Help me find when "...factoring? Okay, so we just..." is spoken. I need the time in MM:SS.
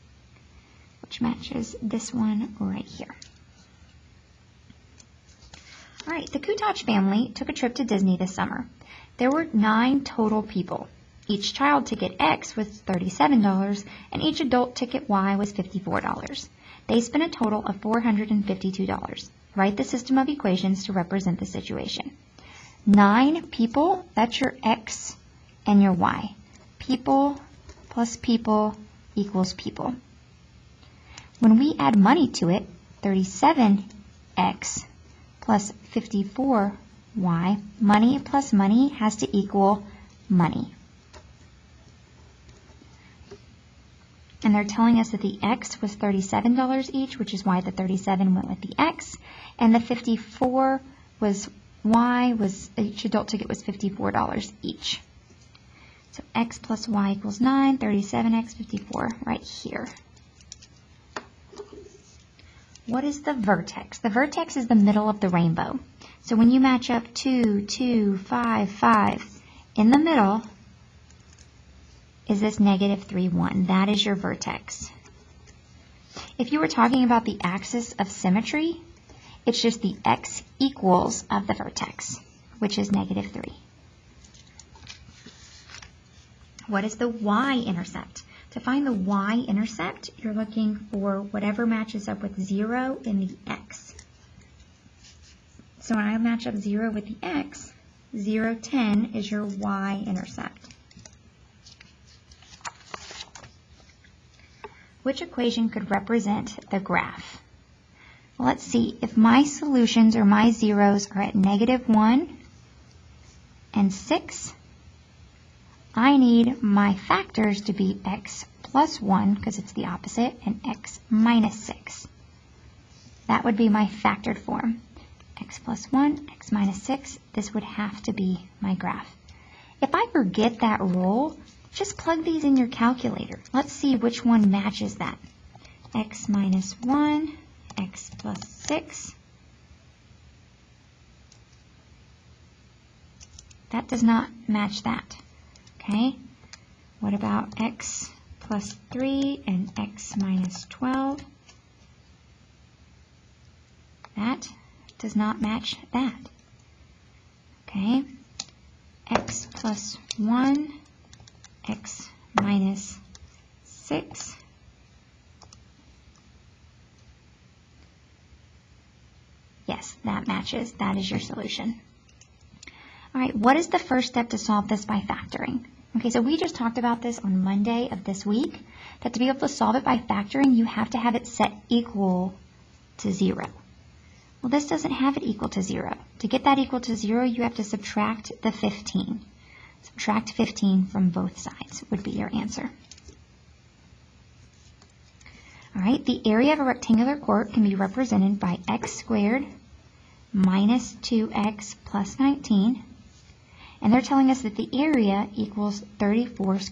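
02:55.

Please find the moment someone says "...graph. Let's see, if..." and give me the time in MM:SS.
01:46.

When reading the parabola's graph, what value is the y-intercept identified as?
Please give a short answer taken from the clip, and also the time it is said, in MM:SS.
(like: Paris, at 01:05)
10, at 01:38.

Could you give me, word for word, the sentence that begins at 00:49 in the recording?
And the 54 was Y was, each adult ticket was $54 each.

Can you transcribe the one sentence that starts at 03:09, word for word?
Subtract 15 from both sides would be your answer.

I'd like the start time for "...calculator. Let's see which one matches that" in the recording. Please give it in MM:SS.
02:12.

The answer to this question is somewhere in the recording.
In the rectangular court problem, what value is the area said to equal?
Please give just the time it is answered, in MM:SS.
03:25.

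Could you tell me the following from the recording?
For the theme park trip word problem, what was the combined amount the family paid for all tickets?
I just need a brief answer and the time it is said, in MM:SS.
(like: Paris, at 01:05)
$452, at 00:17.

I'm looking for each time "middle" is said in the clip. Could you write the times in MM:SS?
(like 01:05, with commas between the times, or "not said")
01:04, 01:09.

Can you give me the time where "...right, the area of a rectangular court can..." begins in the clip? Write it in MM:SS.
03:15.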